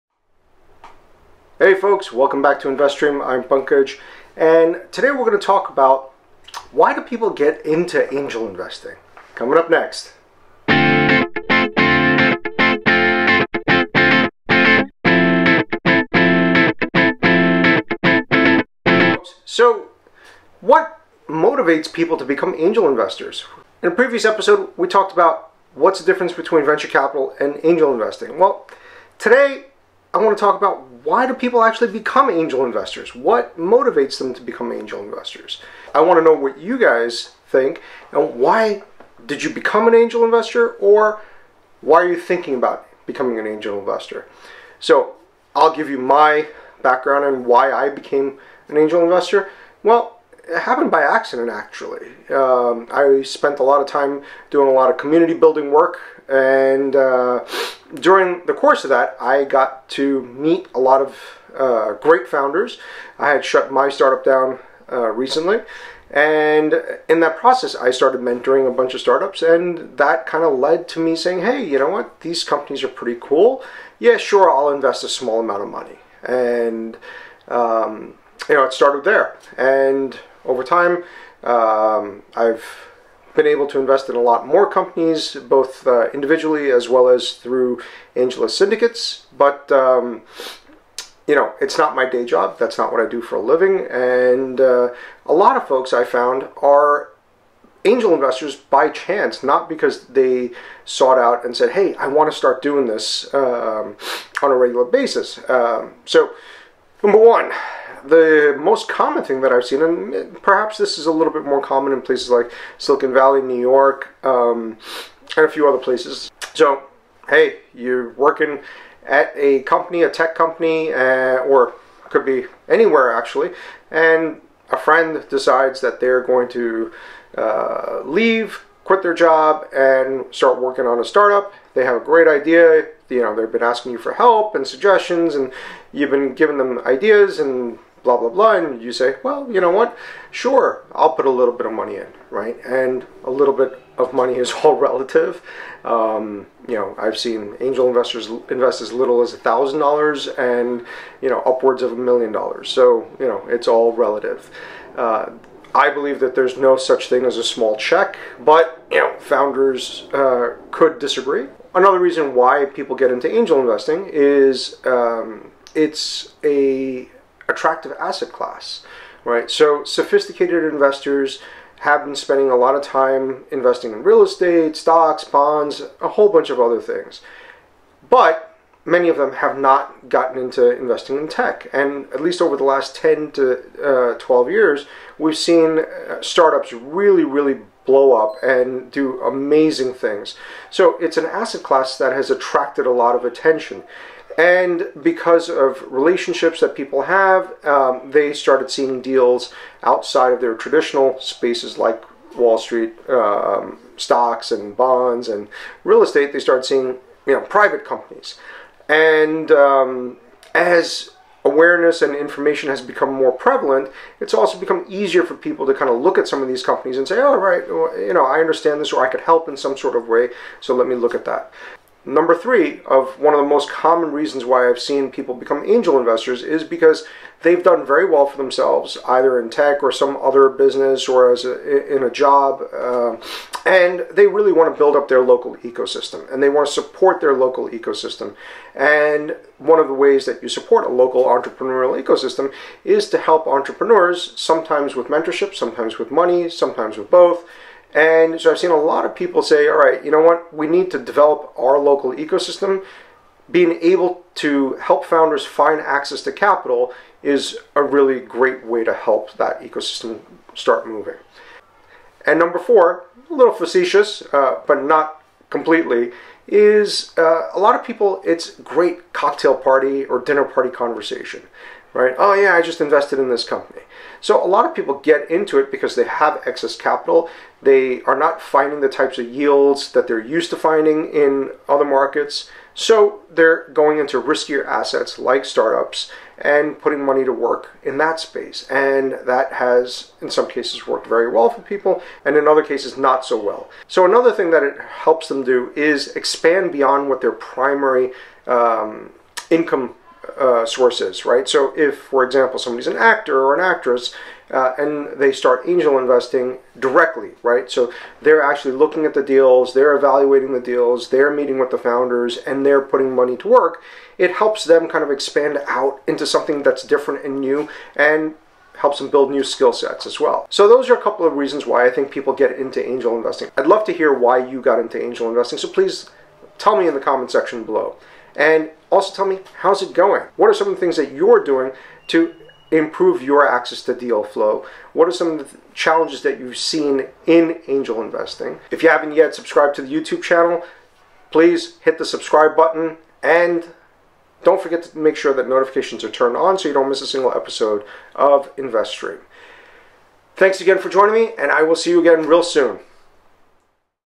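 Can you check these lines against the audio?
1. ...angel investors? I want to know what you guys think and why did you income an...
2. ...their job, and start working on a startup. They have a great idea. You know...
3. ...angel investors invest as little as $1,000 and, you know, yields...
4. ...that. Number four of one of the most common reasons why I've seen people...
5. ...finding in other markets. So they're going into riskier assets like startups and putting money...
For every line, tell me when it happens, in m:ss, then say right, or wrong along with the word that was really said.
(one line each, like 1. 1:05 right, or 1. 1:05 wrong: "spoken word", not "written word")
1. 0:34 wrong: "become", not "income"
2. 2:09 right
3. 2:27 wrong: "upwards", not "yields"
4. 3:41 wrong: "three", not "four"
5. 4:40 right.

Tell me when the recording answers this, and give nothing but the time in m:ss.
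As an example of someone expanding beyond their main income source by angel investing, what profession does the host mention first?
5:02.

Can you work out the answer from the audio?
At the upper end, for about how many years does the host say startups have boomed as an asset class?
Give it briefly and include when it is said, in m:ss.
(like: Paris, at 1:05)
12, at 3:04.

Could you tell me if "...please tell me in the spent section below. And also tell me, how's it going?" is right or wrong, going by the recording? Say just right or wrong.
wrong.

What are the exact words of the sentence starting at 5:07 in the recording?
So they're actually looking at the deals, they're evaluating the deals, they're meeting with the founders, and they're putting money to work.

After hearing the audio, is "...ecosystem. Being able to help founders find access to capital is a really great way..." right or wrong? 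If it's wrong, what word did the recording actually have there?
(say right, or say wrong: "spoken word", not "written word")
right.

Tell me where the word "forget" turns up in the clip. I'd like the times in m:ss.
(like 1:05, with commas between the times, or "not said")
5:44.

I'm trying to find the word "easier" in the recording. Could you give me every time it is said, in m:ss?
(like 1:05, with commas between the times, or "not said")
3:34.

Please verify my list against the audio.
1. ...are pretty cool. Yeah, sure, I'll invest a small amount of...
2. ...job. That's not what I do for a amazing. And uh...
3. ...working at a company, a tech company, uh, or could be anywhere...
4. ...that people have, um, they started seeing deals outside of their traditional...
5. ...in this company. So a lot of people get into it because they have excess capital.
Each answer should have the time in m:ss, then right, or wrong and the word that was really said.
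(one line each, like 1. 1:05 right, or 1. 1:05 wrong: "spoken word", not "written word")
1. 1:12 right
2. 1:32 wrong: "living", not "amazing"
3. 1:58 right
4. 3:16 right
5. 4:33 right.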